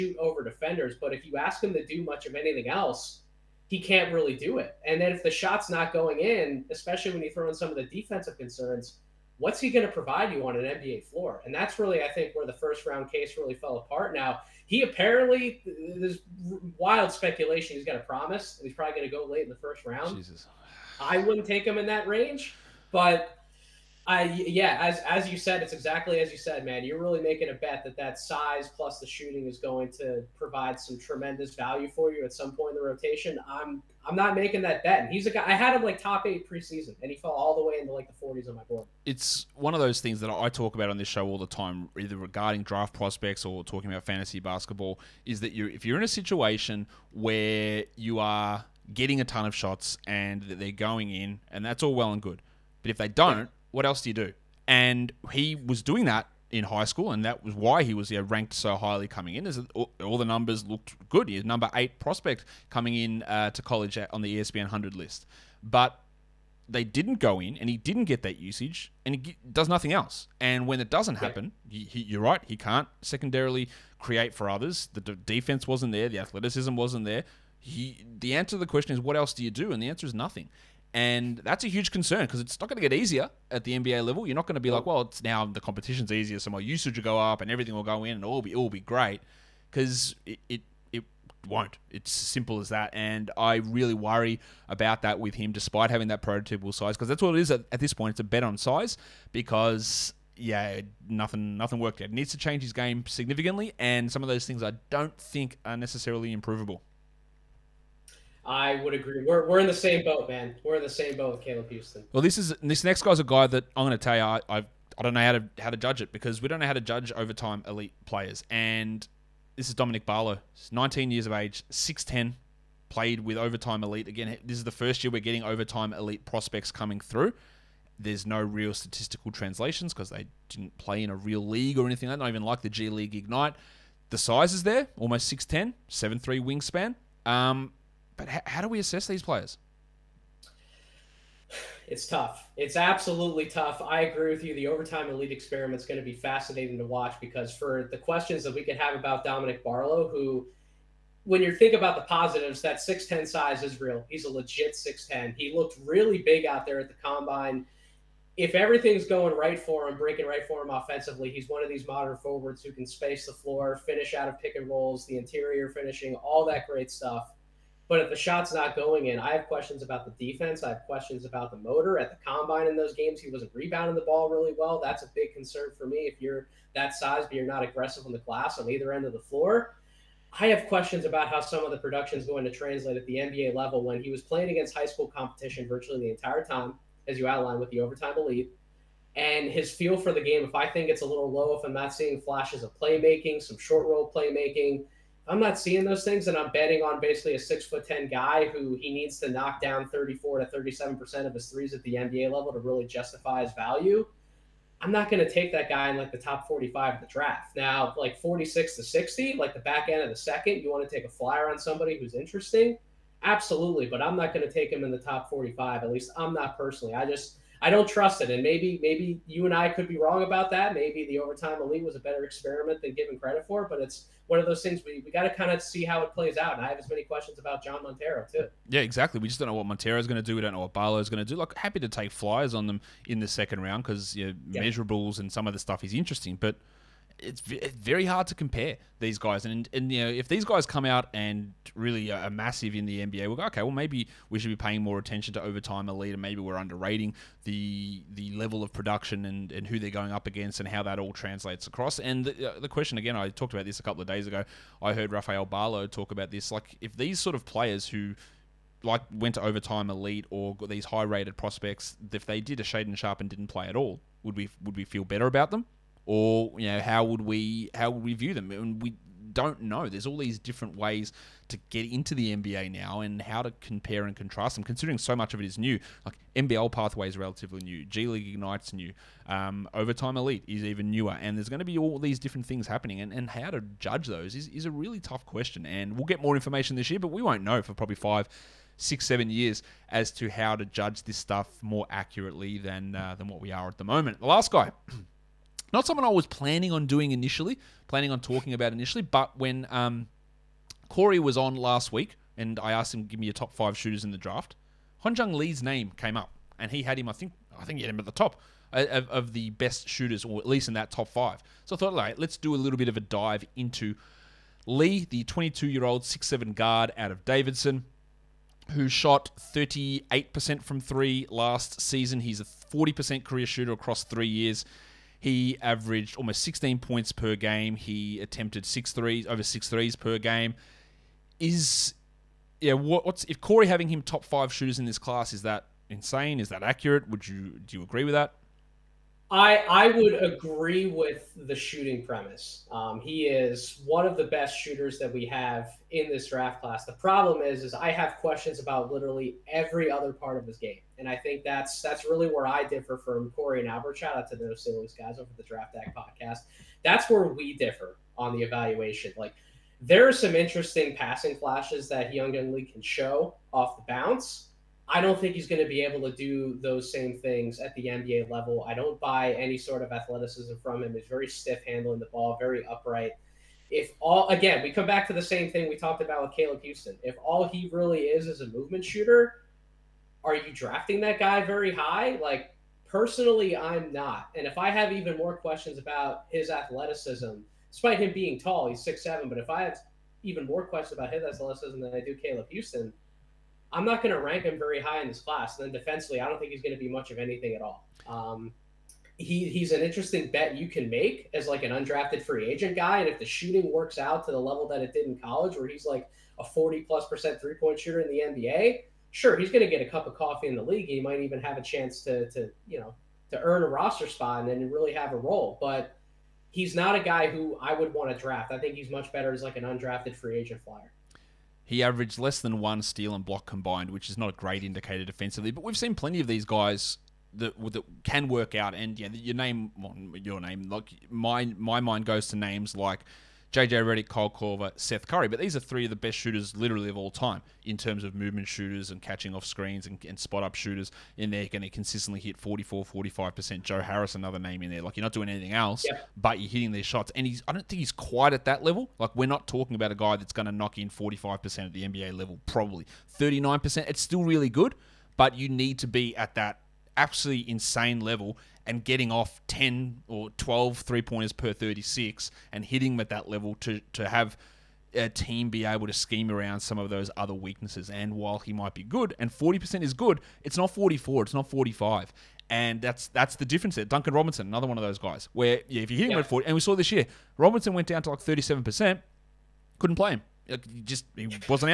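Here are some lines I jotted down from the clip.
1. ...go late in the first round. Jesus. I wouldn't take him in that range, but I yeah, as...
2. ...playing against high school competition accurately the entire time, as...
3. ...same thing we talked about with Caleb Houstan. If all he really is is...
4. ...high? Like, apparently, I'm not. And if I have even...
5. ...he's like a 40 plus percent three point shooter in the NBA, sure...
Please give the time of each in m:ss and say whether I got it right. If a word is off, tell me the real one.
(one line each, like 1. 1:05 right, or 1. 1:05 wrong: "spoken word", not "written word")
1. 0:19 right
2. 3:04 wrong: "virtually", not "accurately"
3. 6:15 right
4. 6:21 wrong: "personally", not "apparently"
5. 6:45 right.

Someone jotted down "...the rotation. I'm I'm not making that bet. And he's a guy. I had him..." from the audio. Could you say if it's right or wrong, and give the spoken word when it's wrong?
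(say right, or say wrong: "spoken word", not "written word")
right.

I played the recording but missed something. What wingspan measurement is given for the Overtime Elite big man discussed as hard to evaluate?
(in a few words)
7'3.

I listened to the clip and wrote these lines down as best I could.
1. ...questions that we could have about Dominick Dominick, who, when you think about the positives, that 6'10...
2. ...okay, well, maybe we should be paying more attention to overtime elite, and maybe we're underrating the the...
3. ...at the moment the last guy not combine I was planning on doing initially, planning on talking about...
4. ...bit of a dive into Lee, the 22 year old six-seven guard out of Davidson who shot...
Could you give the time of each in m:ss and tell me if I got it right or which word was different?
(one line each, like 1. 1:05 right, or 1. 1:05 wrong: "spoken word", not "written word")
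1. 2:27 wrong: "Barlow", not "Dominick"
2. 4:03 right
3. 4:53 wrong: "someone", not "combine"
4. 5:12 right.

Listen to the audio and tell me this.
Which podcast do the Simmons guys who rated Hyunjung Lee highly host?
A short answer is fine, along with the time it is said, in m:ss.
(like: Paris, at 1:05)
Draft Act, at 5:55.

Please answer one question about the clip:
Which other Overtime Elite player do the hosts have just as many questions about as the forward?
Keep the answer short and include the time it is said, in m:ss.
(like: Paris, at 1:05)
John Montero, at 3:47.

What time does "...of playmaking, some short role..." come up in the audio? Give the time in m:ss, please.
3:12.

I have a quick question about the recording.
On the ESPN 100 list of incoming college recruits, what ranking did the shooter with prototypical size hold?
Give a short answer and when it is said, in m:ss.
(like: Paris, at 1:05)
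8, at 1:01.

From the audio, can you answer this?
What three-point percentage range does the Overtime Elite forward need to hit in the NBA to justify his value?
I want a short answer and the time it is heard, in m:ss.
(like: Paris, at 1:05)
34 to 37 percent, at 3:19.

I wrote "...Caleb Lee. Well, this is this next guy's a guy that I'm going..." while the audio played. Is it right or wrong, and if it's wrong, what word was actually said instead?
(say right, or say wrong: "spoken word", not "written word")
wrong: "Houstan", not "Lee".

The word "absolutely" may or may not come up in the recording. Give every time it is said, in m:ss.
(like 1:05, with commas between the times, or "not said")
2:22, 3:33, 7:36.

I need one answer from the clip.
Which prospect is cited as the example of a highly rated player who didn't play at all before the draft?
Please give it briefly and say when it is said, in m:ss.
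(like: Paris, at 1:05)
Shaedon Sharpe, at 4:22.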